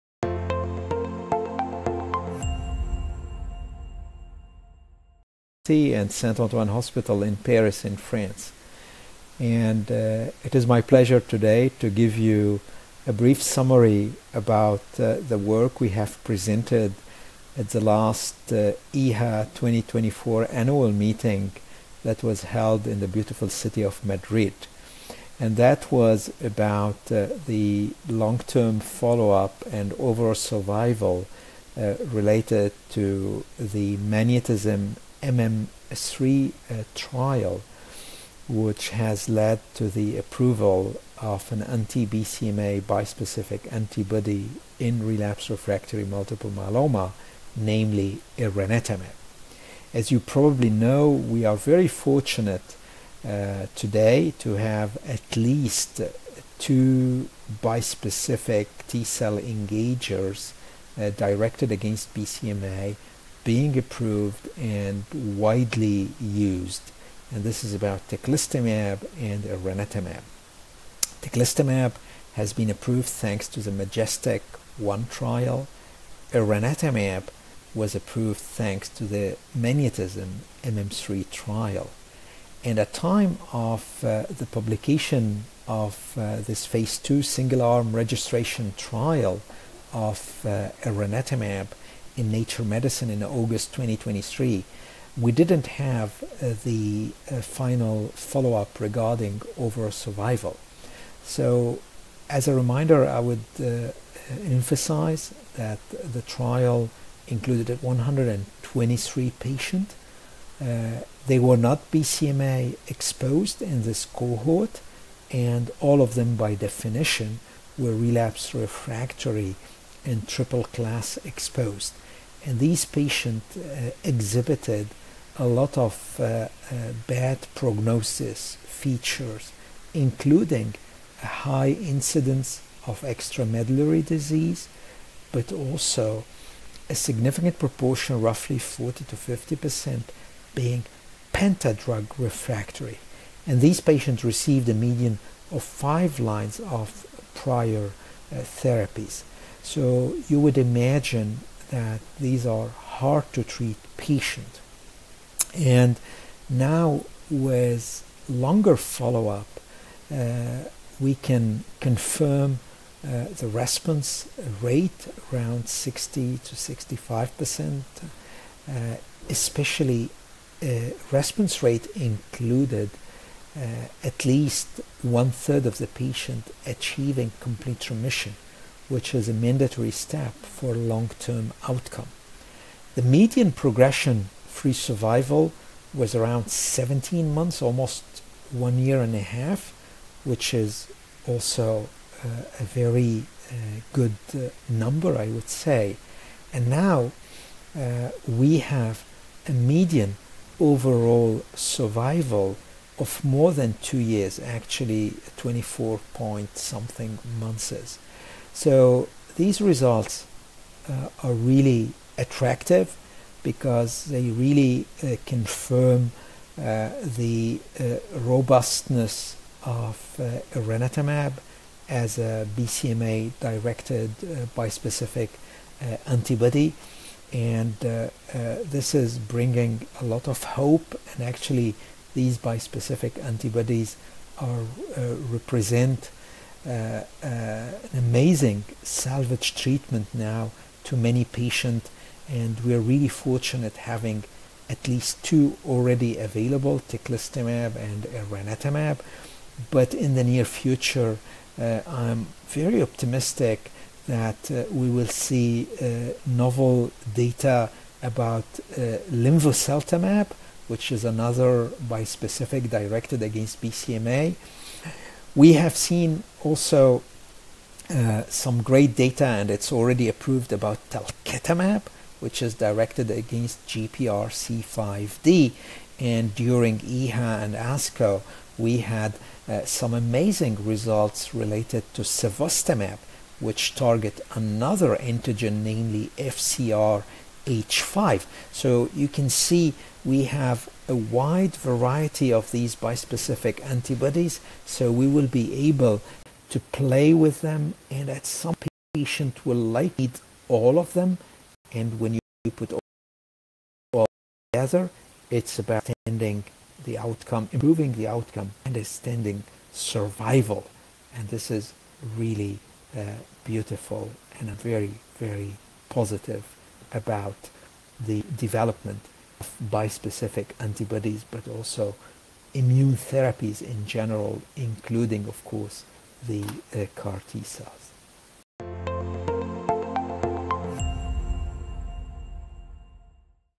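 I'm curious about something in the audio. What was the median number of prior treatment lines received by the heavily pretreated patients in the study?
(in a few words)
5.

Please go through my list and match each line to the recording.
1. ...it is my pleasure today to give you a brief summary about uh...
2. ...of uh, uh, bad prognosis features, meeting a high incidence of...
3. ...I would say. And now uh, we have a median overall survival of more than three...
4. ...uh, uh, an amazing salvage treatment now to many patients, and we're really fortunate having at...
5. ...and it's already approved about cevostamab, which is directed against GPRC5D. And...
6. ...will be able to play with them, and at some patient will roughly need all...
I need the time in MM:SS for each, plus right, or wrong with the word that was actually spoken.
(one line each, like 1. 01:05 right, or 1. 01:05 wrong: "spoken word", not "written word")
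1. 00:10 right
2. 02:05 wrong: "including", not "meeting"
3. 03:15 wrong: "two", not "three"
4. 03:56 right
5. 04:29 wrong: "talquetamab", not "cevostamab"
6. 04:55 wrong: "likely", not "roughly".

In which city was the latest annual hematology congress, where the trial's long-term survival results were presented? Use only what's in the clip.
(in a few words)
Madrid.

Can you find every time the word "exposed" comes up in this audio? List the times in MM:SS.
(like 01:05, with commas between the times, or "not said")
01:52, 02:01.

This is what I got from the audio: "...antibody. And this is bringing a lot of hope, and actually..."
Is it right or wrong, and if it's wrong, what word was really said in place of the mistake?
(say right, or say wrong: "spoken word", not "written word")
right.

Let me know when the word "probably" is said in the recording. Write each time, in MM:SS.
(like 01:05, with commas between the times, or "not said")
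00:50.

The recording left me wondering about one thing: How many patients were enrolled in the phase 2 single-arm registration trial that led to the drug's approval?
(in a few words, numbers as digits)
123.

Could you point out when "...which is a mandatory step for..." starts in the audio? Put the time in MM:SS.
02:58.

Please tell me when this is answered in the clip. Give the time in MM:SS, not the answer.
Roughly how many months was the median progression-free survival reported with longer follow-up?
03:06.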